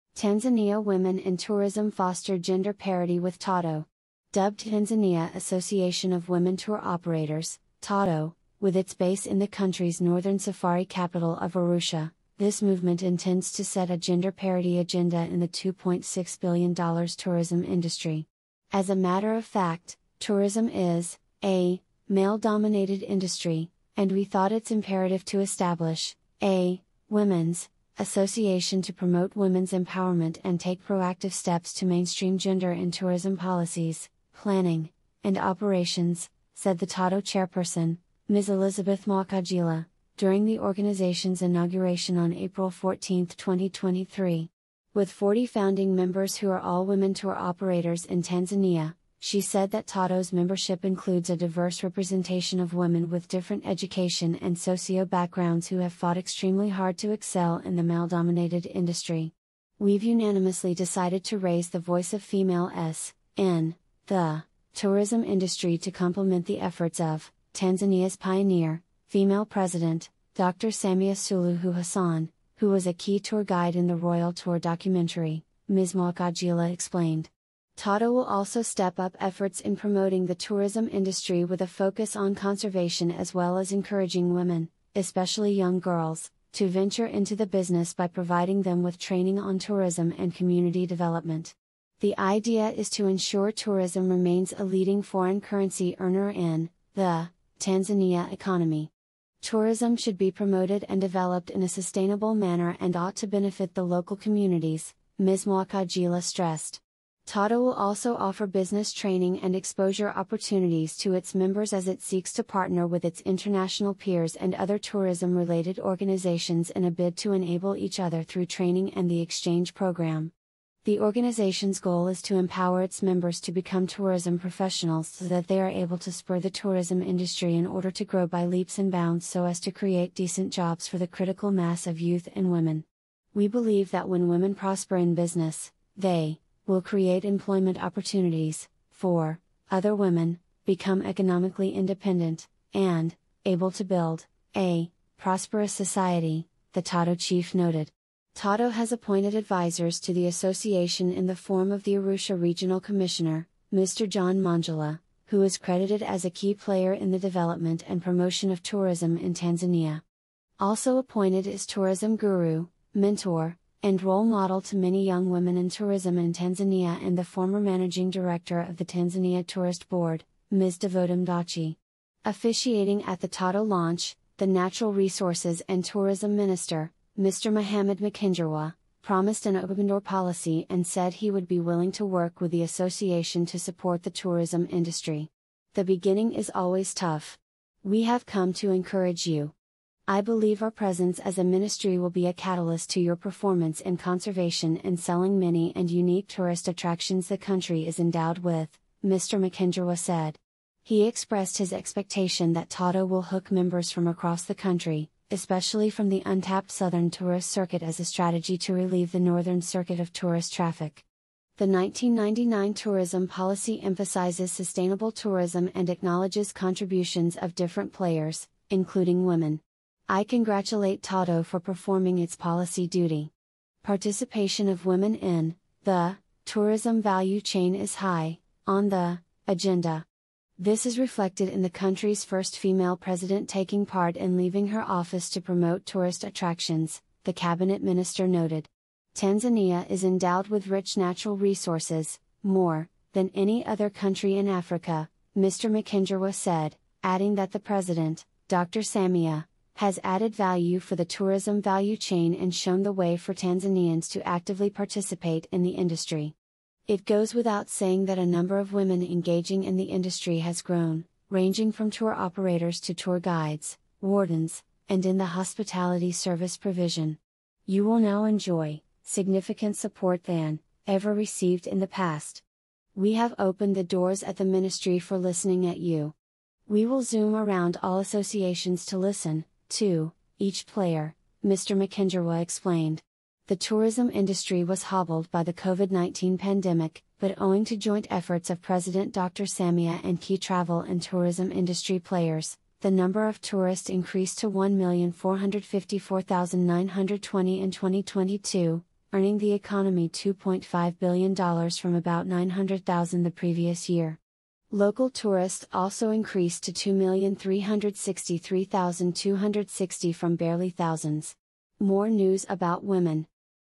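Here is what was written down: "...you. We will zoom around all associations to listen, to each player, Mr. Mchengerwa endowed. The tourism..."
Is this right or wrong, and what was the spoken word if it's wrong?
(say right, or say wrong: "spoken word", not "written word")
wrong: "explained", not "endowed".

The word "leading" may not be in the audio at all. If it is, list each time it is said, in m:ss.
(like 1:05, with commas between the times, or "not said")
1:34.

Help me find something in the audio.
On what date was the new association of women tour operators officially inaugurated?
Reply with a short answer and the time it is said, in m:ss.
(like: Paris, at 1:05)
April 14, 2023, at 0:42.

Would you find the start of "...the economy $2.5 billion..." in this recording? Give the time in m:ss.
4:59.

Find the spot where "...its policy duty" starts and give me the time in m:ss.
3:42.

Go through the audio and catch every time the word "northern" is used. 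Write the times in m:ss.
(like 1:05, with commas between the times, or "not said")
0:09, 3:29.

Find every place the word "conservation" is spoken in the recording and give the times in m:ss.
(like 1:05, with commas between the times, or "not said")
1:22, 3:13.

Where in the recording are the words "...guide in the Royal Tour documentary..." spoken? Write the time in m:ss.
1:13.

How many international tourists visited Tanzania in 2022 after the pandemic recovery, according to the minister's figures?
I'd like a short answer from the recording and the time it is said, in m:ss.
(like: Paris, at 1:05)
1,454,920, at 4:54.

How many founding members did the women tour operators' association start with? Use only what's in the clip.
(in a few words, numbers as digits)
40.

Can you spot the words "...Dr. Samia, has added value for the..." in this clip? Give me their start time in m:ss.
4:08.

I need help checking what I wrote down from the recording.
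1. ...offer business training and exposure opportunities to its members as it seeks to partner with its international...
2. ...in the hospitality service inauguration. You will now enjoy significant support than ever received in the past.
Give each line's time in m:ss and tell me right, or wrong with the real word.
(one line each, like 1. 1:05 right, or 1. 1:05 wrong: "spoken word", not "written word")
1. 1:48 right
2. 4:25 wrong: "provision", not "inauguration".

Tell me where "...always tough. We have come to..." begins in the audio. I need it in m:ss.
3:06.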